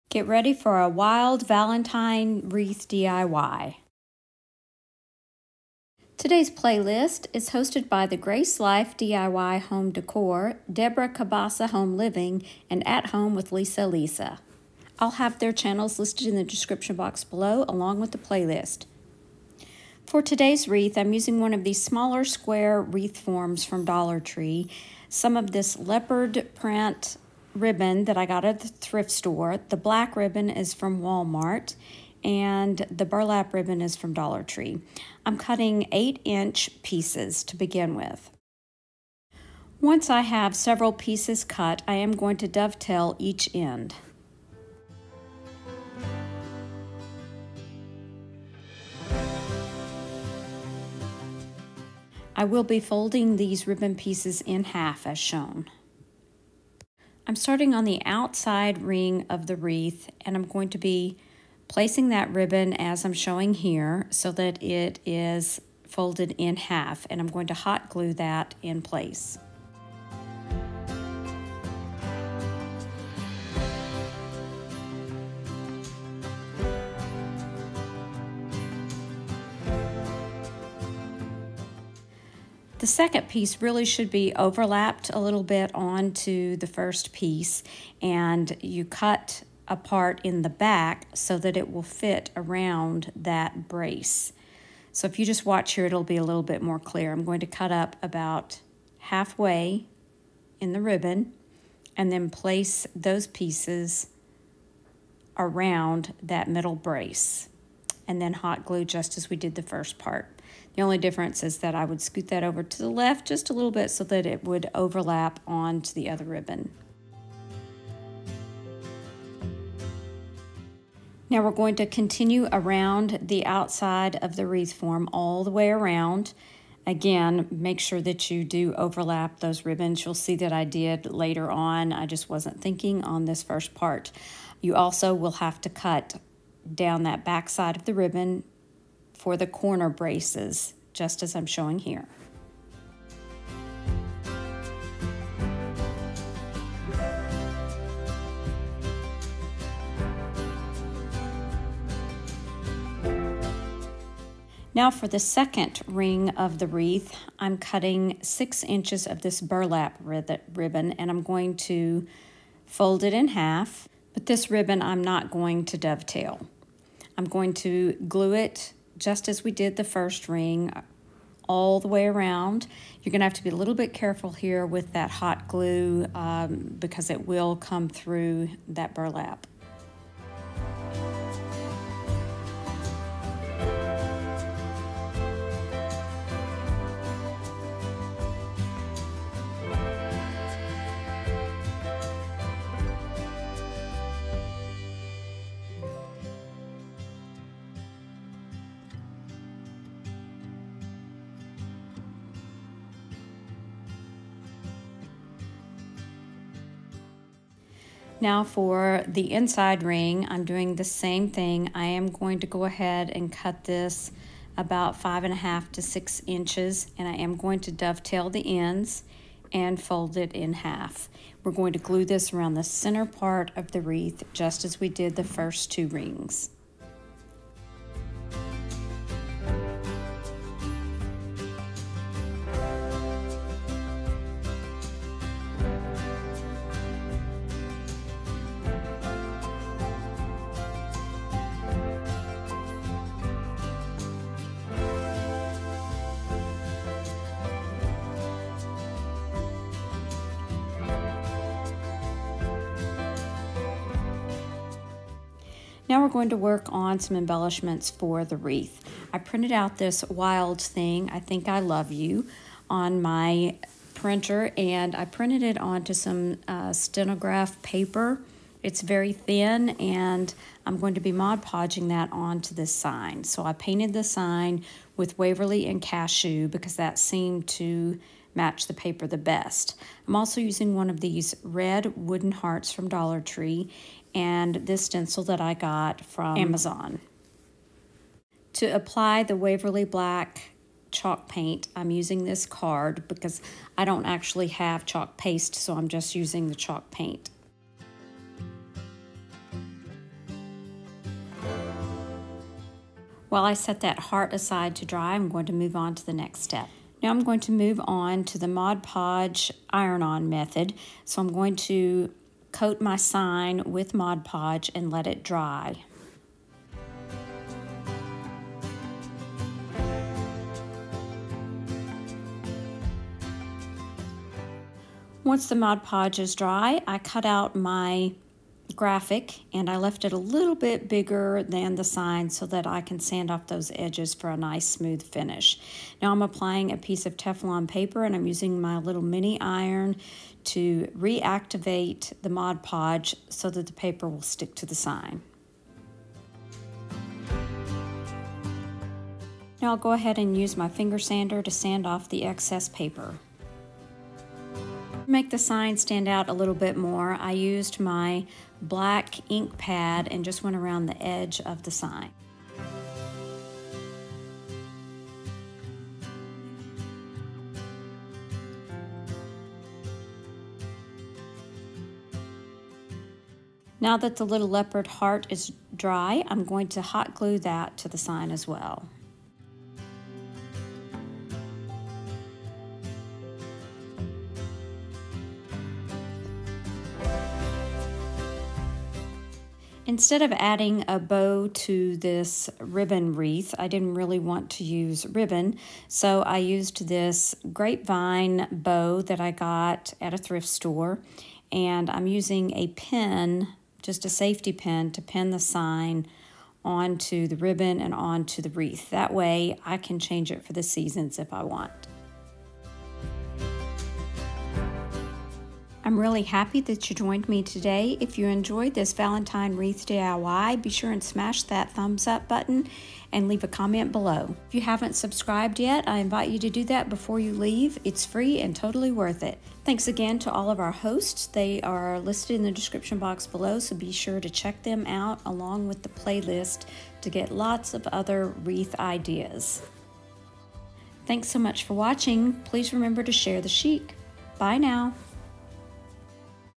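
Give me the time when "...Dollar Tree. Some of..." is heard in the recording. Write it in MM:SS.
00:23.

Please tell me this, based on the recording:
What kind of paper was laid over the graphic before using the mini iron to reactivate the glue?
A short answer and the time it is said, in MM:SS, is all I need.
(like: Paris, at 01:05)
Teflon paper, at 05:37.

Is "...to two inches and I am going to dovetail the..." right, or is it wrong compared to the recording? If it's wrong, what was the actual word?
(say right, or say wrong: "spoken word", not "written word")
wrong: "six", not "two".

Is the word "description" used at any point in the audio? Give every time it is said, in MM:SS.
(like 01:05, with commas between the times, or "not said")
00:16, 07:12.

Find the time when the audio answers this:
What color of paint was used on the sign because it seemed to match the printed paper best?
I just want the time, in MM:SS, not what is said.
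04:35.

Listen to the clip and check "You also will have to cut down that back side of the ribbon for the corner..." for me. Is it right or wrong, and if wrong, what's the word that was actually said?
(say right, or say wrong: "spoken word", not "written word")
right.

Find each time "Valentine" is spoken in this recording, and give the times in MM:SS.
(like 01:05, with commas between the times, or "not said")
00:01, 06:58.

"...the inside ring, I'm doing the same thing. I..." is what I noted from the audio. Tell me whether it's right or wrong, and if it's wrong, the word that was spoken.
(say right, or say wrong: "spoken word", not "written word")
right.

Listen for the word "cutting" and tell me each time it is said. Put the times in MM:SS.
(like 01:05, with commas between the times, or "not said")
00:35, 02:37.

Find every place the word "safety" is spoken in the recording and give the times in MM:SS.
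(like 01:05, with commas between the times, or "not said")
06:44.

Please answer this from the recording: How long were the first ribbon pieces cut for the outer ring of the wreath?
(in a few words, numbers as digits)
8 inches.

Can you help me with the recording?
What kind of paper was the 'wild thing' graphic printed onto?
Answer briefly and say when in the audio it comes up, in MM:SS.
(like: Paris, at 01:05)
Stenograph paper, at 04:26.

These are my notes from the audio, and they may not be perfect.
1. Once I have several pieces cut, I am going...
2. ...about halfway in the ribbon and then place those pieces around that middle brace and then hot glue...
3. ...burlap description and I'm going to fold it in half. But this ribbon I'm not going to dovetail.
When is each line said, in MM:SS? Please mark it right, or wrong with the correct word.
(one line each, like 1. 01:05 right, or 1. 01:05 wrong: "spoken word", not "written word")
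1. 00:39 right
2. 01:38 right
3. 02:39 wrong: "ribbon", not "description".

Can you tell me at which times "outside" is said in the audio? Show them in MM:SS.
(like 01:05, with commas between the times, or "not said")
00:58, 02:03.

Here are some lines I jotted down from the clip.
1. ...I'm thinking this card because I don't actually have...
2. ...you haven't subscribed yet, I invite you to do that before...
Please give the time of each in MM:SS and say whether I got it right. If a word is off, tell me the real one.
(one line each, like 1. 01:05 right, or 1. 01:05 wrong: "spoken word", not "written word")
1. 04:51 wrong: "using", not "thinking"
2. 07:04 right.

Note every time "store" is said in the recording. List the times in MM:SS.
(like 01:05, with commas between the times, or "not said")
00:29, 06:40.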